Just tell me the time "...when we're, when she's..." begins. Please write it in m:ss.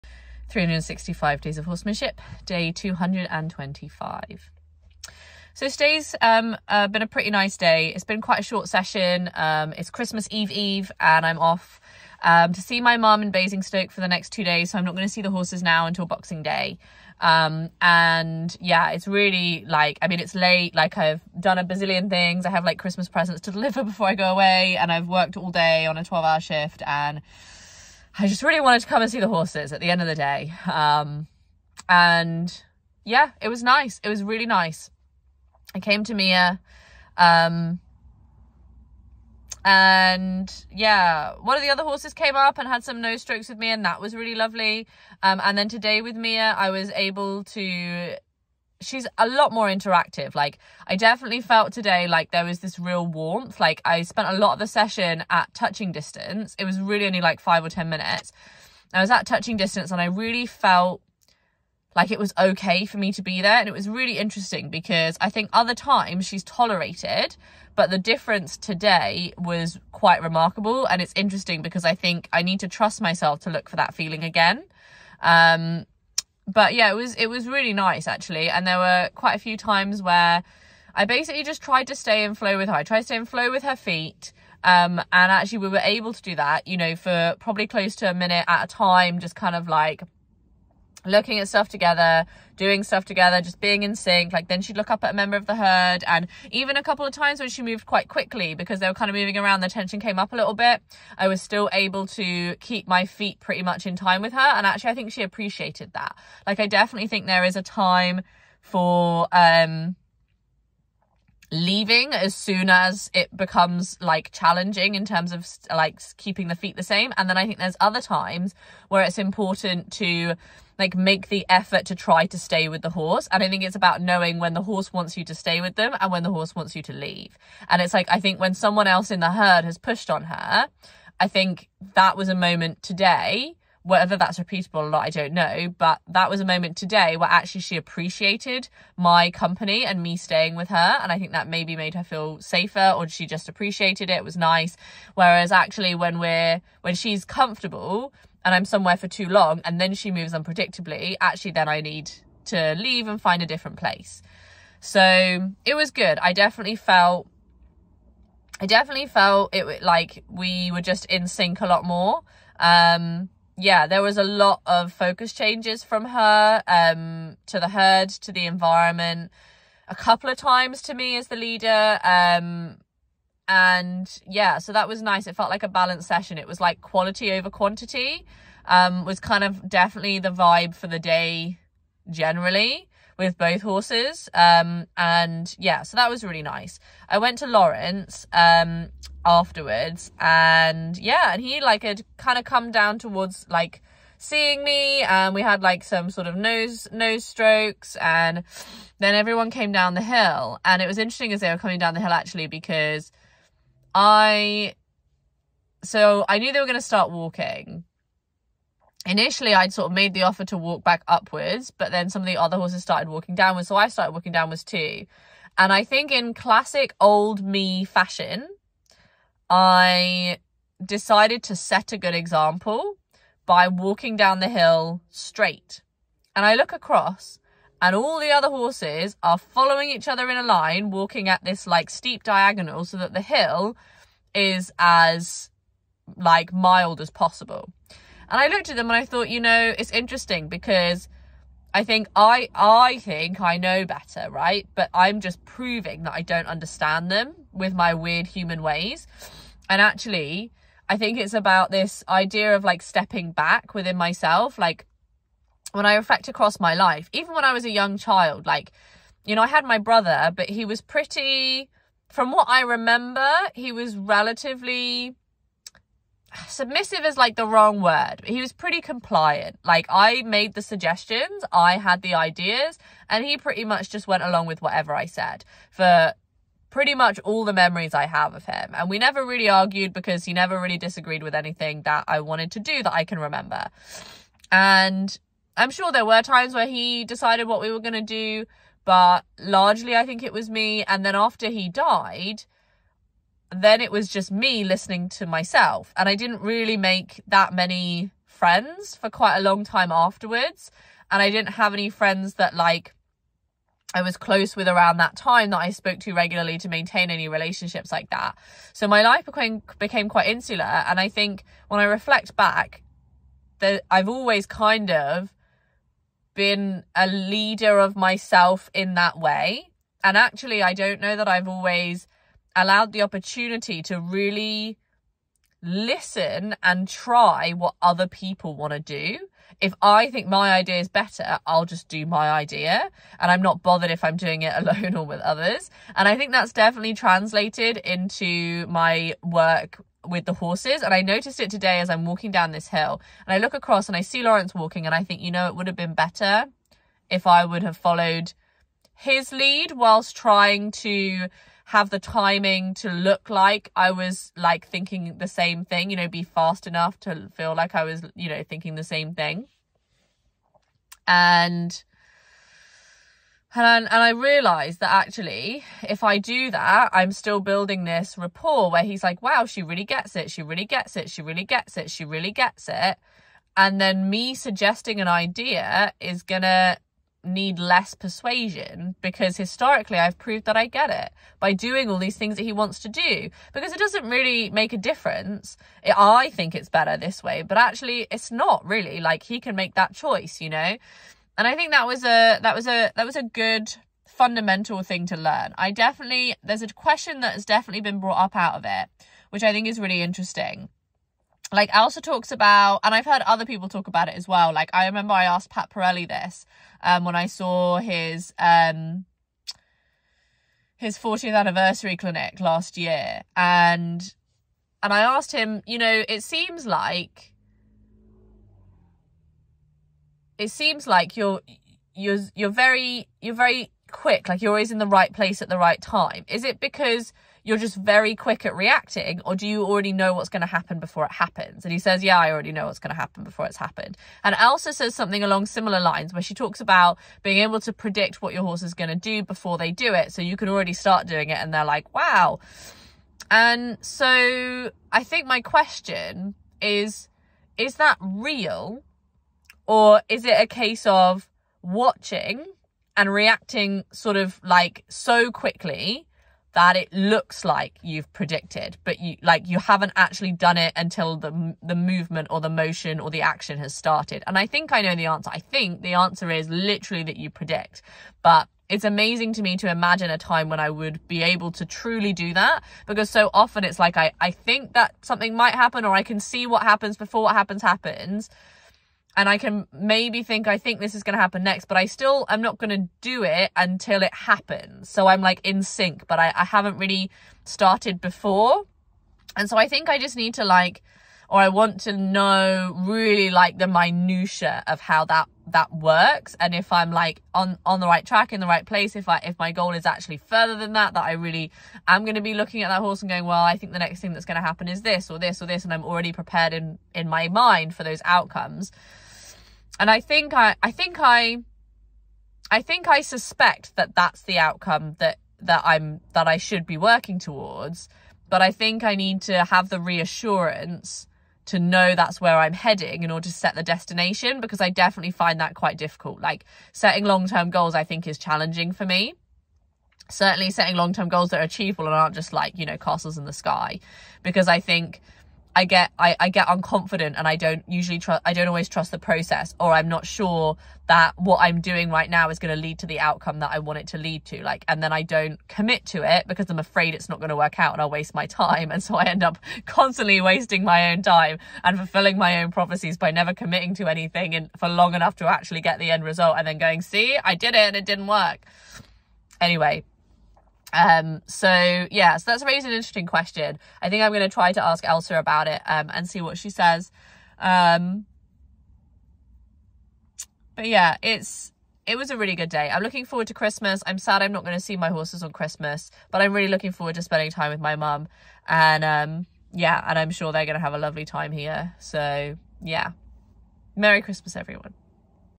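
2:25.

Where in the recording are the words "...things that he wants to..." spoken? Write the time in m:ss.
6:22.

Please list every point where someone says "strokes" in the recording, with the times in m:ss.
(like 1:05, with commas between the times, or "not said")
0:43, 3:17.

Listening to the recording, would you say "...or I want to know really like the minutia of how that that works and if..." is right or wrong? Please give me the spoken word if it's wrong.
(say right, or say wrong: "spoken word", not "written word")
right.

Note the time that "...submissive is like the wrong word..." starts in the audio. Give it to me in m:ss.
4:26.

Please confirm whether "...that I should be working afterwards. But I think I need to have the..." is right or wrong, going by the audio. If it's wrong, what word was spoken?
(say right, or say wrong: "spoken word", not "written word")
wrong: "towards", not "afterwards".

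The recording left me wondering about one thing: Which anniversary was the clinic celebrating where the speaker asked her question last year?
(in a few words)
40th.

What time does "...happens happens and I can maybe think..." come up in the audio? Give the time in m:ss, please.
7:57.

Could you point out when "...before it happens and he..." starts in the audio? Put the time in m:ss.
7:10.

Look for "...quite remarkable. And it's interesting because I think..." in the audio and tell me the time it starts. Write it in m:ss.
1:09.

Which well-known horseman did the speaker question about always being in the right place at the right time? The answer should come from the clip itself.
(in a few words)
Pat Parelli.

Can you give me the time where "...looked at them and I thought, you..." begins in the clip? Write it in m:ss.
3:58.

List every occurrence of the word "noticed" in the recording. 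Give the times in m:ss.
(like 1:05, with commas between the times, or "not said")
5:41.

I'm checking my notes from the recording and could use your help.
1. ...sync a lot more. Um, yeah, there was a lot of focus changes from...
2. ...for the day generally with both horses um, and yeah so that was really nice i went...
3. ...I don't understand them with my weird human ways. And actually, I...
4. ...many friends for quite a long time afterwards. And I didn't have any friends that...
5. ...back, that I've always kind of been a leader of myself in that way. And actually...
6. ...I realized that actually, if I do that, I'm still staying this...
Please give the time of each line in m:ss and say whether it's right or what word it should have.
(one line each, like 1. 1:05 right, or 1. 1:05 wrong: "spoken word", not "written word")
1. 2:41 right
2. 3:00 right
3. 4:06 right
4. 4:57 right
5. 5:12 right
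6. 6:04 wrong: "building", not "staying".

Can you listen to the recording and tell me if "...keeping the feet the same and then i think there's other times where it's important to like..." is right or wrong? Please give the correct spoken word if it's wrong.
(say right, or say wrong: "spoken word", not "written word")
right.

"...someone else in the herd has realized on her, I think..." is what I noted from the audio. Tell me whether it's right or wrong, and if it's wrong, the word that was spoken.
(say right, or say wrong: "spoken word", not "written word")
wrong: "pushed", not "realized".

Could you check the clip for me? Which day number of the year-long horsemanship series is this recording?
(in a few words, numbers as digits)
225.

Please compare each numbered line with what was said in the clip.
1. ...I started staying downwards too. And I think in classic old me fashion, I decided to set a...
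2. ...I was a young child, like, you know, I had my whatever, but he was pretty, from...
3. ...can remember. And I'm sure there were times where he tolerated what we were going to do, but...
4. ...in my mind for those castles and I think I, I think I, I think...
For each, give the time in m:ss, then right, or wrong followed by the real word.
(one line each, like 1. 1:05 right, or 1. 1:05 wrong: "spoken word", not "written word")
1. 3:33 wrong: "walking", not "staying"
2. 4:17 wrong: "brother", not "whatever"
3. 4:43 wrong: "decided", not "tolerated"
4. 8:26 wrong: "outcomes", not "castles".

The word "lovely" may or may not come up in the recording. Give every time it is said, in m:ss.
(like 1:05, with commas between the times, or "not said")
0:44, 9:40.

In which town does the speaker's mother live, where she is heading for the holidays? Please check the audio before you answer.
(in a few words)
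Basingstoke.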